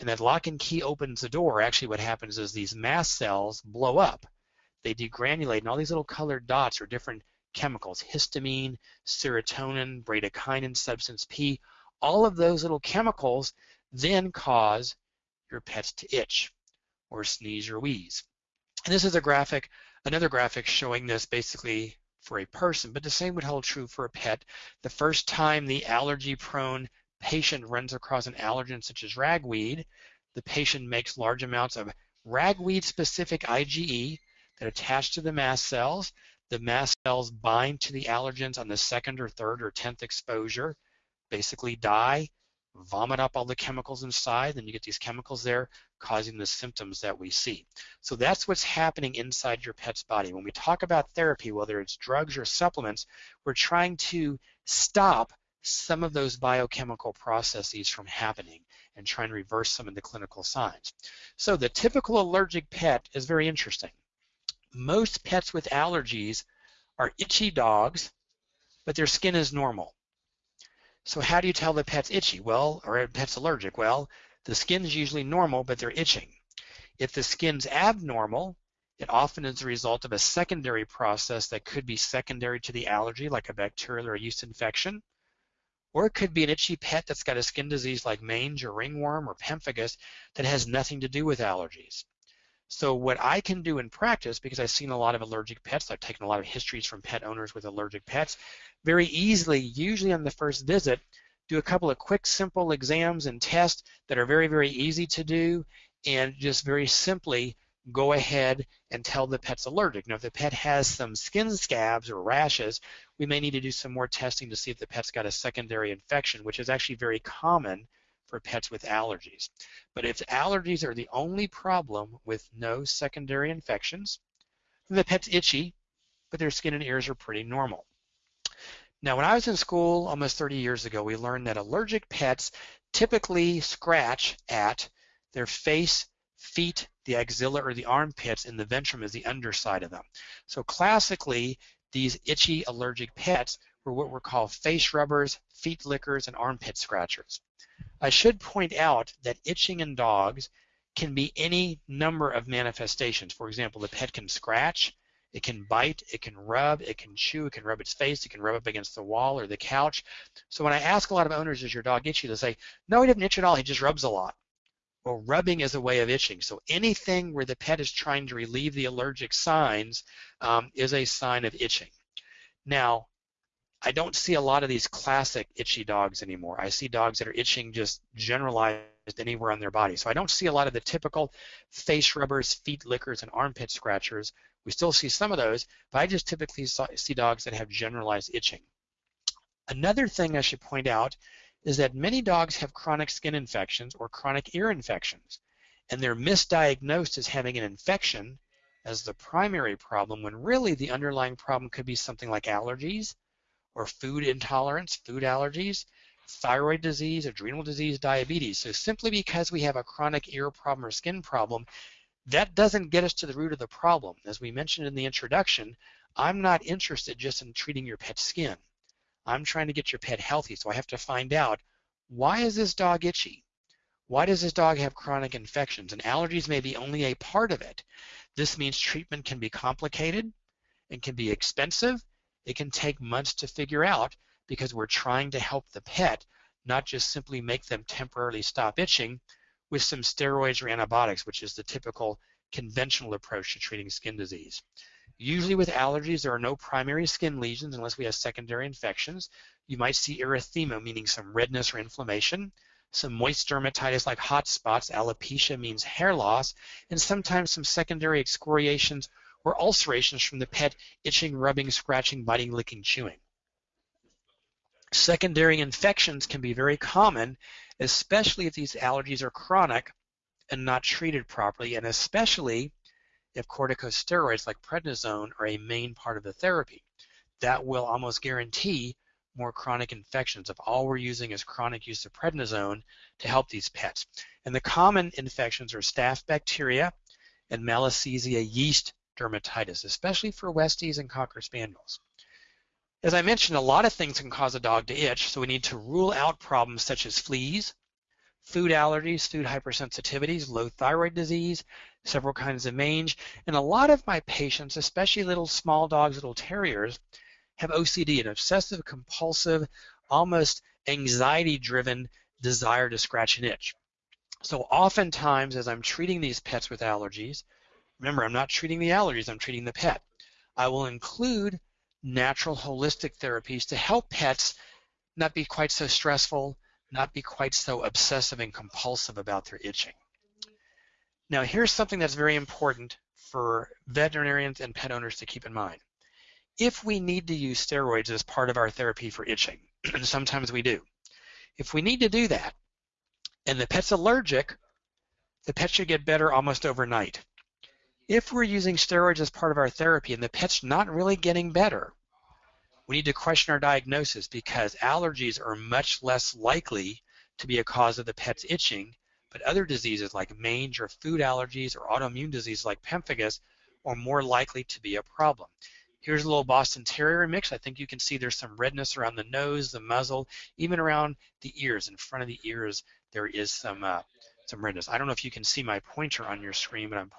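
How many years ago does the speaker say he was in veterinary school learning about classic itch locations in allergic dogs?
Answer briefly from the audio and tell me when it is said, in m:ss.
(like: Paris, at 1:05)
30, at 2:10.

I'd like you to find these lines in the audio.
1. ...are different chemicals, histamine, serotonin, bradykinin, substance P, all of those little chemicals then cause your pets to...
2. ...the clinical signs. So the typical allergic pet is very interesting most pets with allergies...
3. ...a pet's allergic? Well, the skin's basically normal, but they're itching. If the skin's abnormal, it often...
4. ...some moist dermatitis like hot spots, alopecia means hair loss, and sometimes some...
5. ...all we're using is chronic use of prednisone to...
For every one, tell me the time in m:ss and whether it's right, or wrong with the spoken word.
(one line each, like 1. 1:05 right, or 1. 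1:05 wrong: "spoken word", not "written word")
1. 0:06 right
2. 0:59 right
3. 1:12 wrong: "usually", not "basically"
4. 4:12 right
5. 4:40 right.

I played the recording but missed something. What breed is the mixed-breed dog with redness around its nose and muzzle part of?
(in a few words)
Boston Terrier.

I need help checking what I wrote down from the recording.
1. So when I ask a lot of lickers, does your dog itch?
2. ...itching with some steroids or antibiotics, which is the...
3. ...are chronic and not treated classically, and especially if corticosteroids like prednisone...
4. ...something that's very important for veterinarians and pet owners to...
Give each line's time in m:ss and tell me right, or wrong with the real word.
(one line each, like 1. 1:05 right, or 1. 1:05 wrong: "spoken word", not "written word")
1. 2:40 wrong: "owners", not "lickers"
2. 3:58 right
3. 4:29 wrong: "properly", not "classically"
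4. 5:31 right.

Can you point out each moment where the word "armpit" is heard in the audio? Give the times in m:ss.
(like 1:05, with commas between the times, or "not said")
2:17, 2:26, 3:03.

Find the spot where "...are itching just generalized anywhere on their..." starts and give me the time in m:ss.
2:57.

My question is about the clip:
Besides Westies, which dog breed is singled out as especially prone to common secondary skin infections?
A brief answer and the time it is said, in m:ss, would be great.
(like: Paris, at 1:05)
Cocker Spaniels, at 4:51.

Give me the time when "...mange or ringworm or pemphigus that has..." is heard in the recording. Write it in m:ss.
1:28.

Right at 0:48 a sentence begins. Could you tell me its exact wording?
So that's what's happening inside your pet's body.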